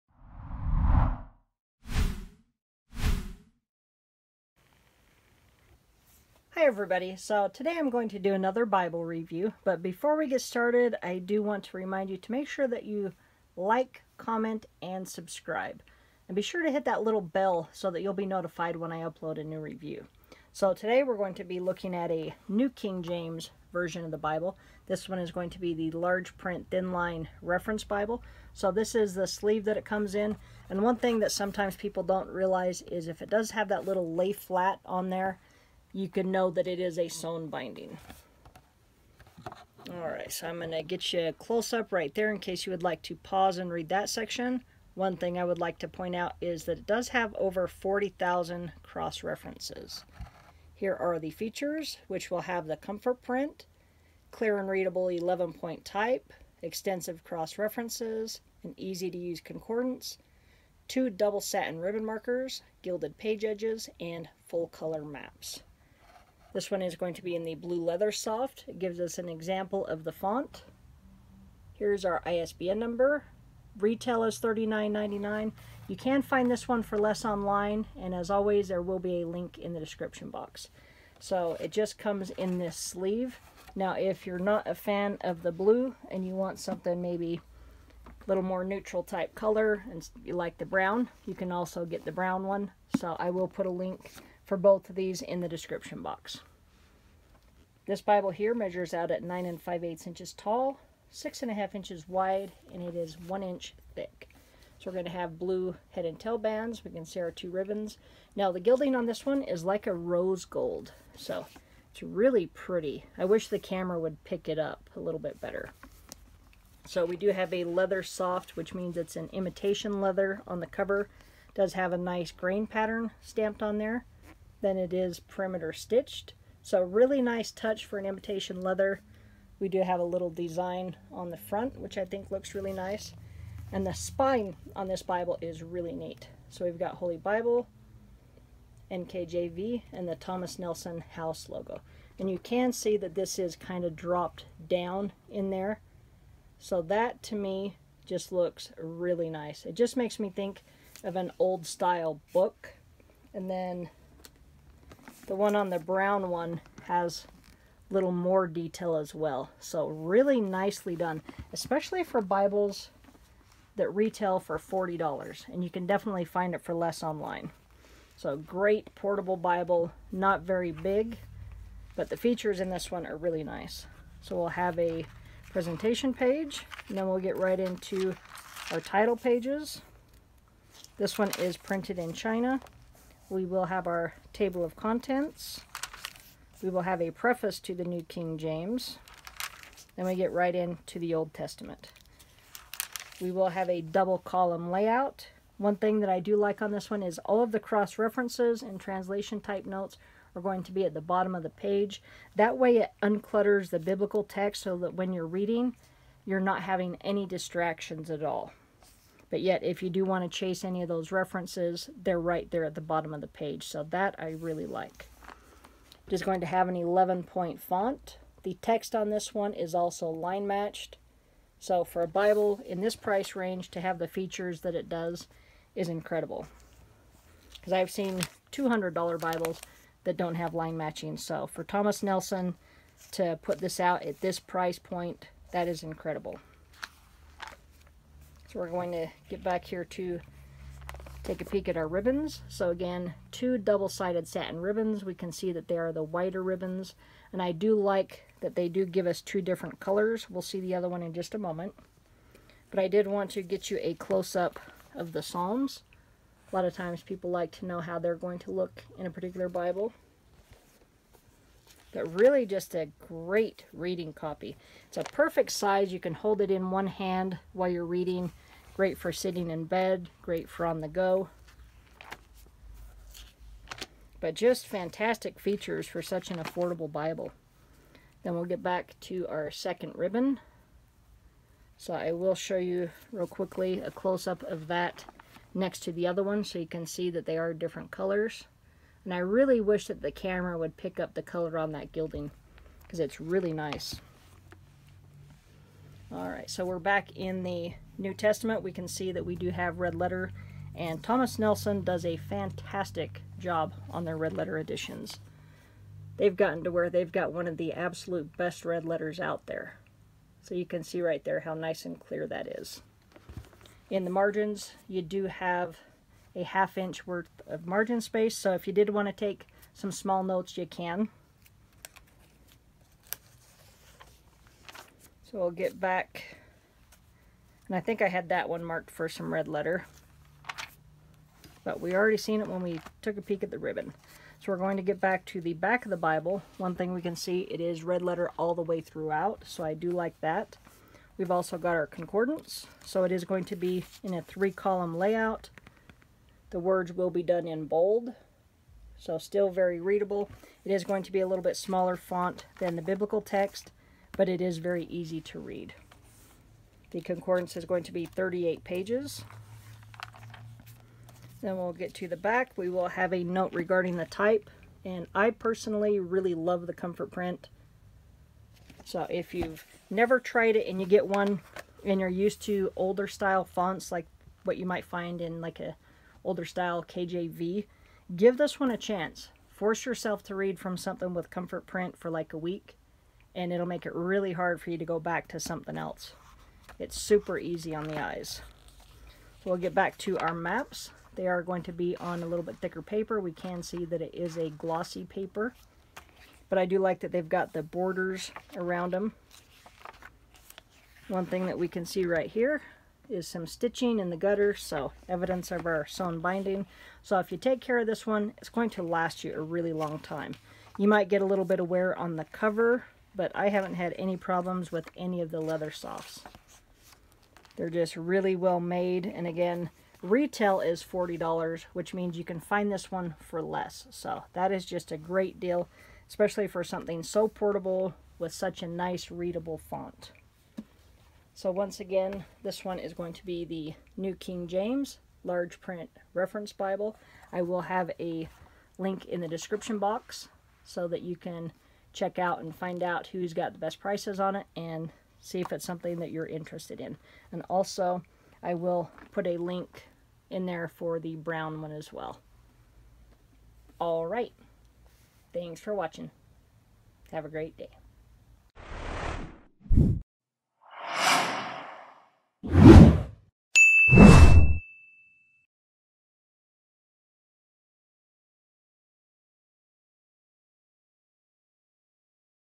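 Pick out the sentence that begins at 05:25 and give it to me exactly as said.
So I'll get back, and I think I had that one marked for some red letter.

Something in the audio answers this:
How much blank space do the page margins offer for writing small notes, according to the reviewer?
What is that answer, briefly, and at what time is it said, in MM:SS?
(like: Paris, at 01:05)
a half inch, at 05:16.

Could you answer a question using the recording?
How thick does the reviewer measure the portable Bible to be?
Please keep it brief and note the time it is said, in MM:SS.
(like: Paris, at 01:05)
1 inch, at 01:43.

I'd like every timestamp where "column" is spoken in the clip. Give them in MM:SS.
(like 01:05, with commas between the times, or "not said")
03:14, 05:44.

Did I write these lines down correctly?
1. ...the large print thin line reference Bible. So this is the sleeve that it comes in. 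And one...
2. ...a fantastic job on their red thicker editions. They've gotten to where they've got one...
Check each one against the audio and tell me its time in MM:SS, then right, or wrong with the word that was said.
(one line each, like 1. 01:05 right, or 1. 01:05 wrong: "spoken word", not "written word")
1. 00:25 right
2. 05:02 wrong: "letter", not "thicker".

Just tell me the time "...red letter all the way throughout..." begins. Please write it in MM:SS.
05:37.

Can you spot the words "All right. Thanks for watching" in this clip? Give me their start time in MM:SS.
07:33.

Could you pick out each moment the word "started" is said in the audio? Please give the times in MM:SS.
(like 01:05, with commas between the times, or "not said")
00:10.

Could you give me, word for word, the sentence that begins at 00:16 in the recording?
And be sure to hit that little bell so that you'll be notified when I upload a new review.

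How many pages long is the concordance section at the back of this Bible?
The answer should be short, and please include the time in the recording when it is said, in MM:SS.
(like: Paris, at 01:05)
38 pages, at 05:58.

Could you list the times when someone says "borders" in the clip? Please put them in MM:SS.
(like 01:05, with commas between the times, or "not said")
06:37.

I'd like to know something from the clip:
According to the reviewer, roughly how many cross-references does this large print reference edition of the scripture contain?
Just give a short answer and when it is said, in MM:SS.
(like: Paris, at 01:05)
over 40,000, at 00:47.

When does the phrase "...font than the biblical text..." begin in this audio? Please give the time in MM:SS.
05:51.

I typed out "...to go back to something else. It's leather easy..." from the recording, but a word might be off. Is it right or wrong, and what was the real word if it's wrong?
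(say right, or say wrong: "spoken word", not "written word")
wrong: "super", not "leather".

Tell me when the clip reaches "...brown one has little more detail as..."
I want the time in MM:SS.
02:35.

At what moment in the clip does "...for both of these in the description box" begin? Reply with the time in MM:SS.
01:34.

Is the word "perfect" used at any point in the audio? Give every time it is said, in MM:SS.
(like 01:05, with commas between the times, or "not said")
04:25.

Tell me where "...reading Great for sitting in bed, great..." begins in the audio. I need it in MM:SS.
04:27.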